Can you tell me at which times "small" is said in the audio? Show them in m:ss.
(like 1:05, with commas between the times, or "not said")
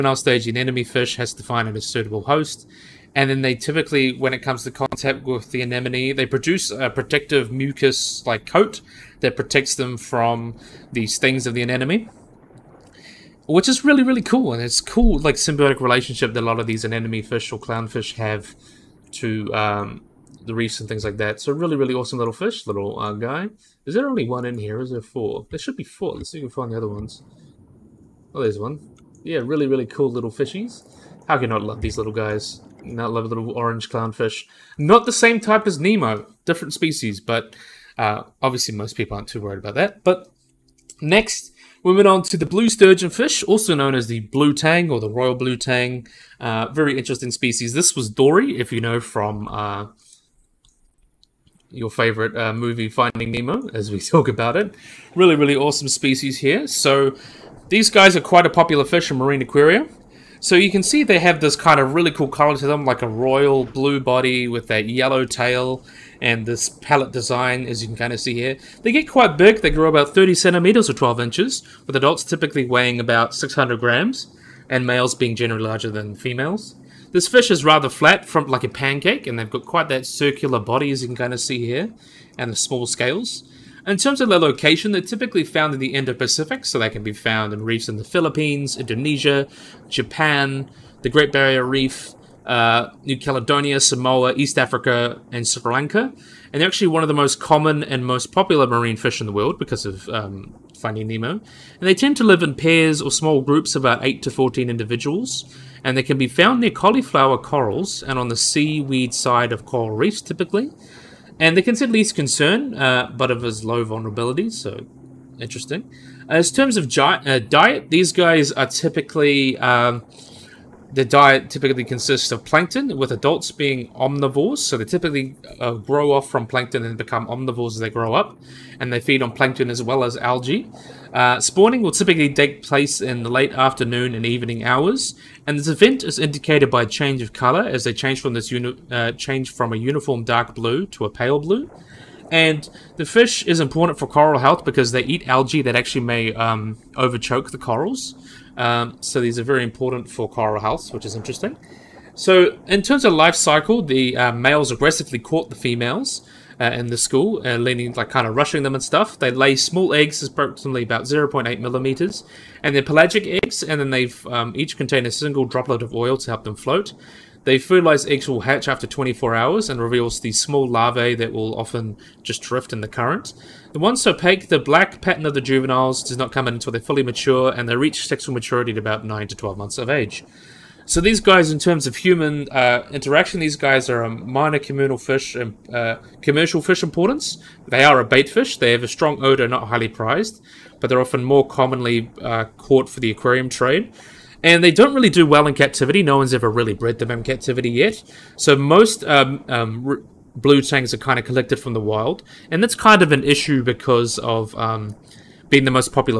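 1:22, 1:43, 2:39, 2:50.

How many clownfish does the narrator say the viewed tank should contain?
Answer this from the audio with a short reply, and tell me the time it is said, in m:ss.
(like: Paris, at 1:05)
4, at 0:25.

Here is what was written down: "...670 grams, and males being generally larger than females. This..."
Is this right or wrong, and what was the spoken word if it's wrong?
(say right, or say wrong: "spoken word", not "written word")
wrong: "600", not "670".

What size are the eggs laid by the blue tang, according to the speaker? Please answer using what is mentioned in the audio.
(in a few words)
0.8 millimeters.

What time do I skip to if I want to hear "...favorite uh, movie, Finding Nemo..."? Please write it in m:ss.
0:51.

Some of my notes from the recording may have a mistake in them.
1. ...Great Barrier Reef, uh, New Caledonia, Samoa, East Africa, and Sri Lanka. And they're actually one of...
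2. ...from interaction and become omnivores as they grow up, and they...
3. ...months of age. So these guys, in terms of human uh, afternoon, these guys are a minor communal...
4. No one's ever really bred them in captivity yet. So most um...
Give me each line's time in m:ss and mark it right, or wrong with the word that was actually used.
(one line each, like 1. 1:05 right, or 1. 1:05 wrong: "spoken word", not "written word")
1. 1:31 right
2. 2:06 wrong: "plankton", not "interaction"
3. 2:59 wrong: "interaction", not "afternoon"
4. 3:16 right.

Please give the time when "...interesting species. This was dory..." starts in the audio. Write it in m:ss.
0:46.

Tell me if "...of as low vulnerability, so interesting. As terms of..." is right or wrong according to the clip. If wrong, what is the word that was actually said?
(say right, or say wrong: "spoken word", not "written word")
right.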